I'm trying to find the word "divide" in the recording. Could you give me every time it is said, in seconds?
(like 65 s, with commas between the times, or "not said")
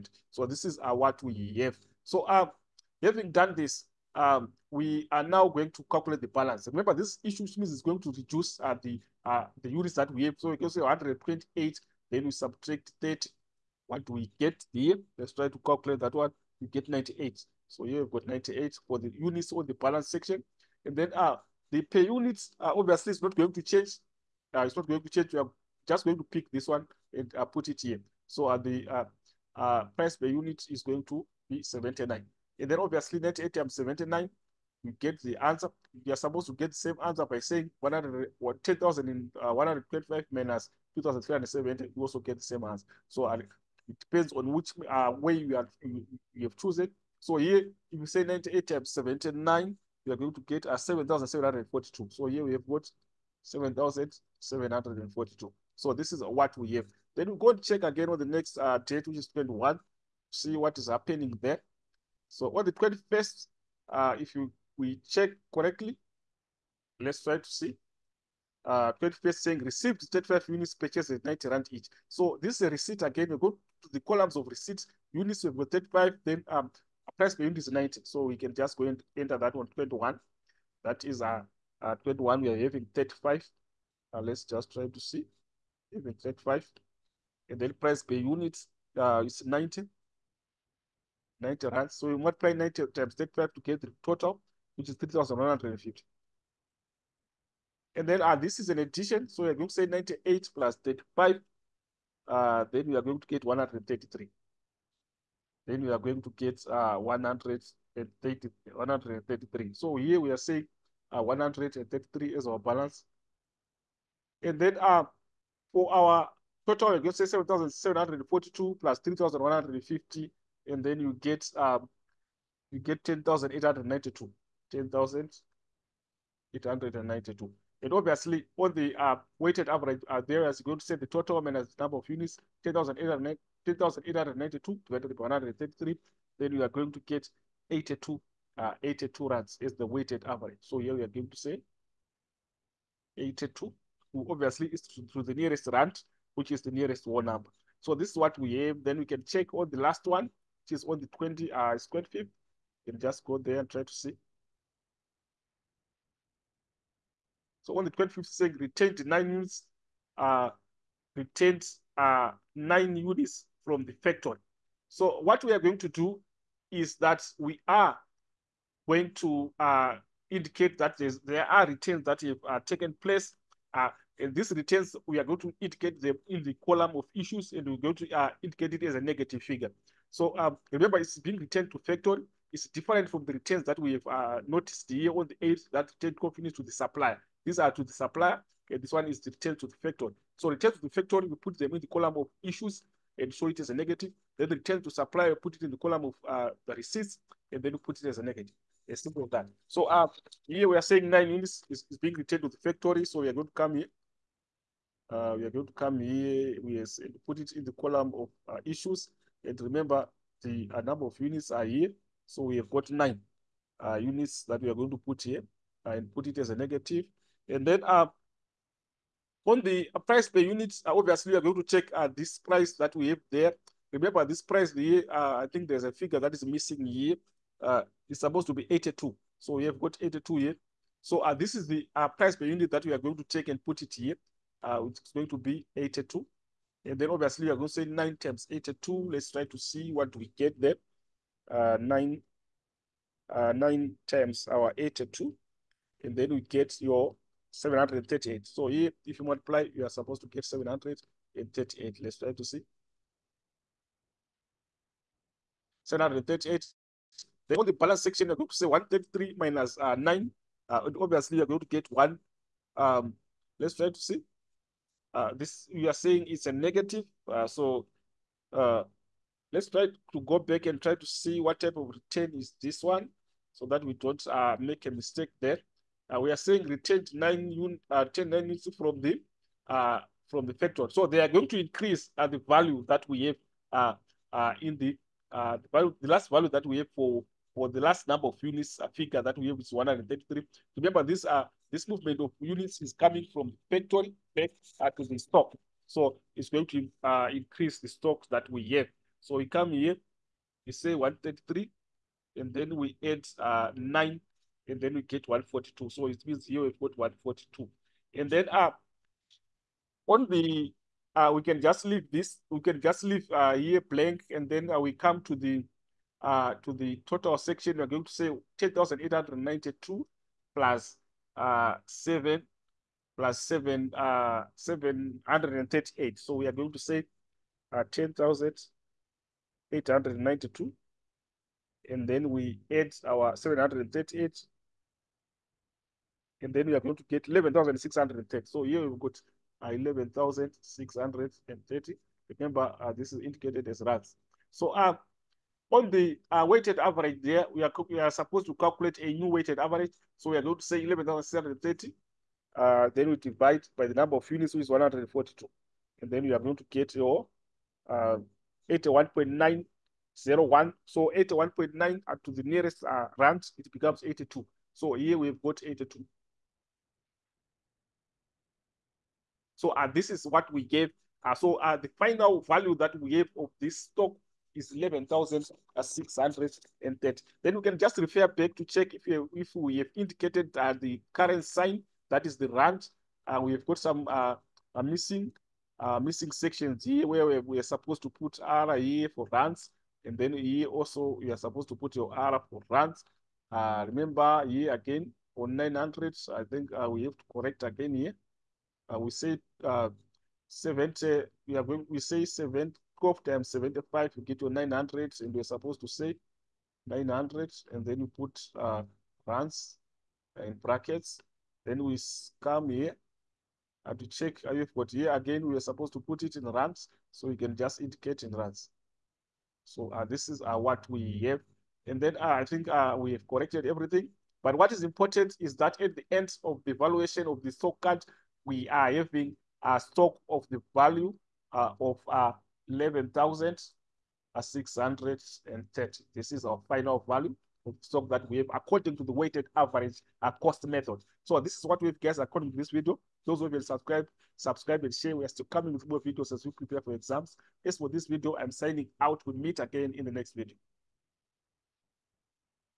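353 s.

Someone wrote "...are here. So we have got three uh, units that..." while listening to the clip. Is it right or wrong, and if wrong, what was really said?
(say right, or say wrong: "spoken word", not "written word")
wrong: "nine", not "three".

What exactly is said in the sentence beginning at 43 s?
So uh, it depends on which uh, way you, are, you, you have chosen.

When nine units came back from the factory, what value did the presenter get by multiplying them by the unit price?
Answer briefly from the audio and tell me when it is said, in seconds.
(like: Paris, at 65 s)
738, at 246 s.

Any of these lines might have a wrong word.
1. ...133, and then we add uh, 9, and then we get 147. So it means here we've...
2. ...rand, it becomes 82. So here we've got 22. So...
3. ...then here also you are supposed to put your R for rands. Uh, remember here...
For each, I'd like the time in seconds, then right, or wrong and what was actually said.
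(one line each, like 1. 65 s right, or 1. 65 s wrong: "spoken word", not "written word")
1. 300 s wrong: "142", not "147"
2. 363 s wrong: "82", not "22"
3. 390 s right.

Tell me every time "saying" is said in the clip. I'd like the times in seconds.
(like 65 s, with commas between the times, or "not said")
37 s, 69 s, 110 s, 158 s, 200 s, 265 s, 276 s.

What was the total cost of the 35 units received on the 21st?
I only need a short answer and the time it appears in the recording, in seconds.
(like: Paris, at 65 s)
3,150, at 94 s.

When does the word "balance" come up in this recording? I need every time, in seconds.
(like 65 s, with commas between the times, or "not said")
6 s, 19 s, 112 s, 257 s.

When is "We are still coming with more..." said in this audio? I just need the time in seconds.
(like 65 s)
445 s.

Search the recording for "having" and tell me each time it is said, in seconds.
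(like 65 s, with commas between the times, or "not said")
3 s, 82 s, 428 s.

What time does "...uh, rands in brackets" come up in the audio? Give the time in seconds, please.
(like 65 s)
408 s.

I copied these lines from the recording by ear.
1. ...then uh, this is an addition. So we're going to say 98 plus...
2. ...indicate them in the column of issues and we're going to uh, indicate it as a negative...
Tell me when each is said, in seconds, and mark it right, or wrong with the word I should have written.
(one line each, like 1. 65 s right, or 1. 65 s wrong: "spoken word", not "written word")
1. 98 s right
2. 175 s right.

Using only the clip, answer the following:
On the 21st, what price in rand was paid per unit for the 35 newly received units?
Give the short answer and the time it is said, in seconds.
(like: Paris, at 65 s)
90, at 70 s.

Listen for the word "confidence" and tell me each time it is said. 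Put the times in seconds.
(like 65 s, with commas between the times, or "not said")
186 s.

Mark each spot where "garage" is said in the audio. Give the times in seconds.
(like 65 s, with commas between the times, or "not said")
not said.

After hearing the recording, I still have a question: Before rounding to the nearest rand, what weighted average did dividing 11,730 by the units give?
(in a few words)
81.901.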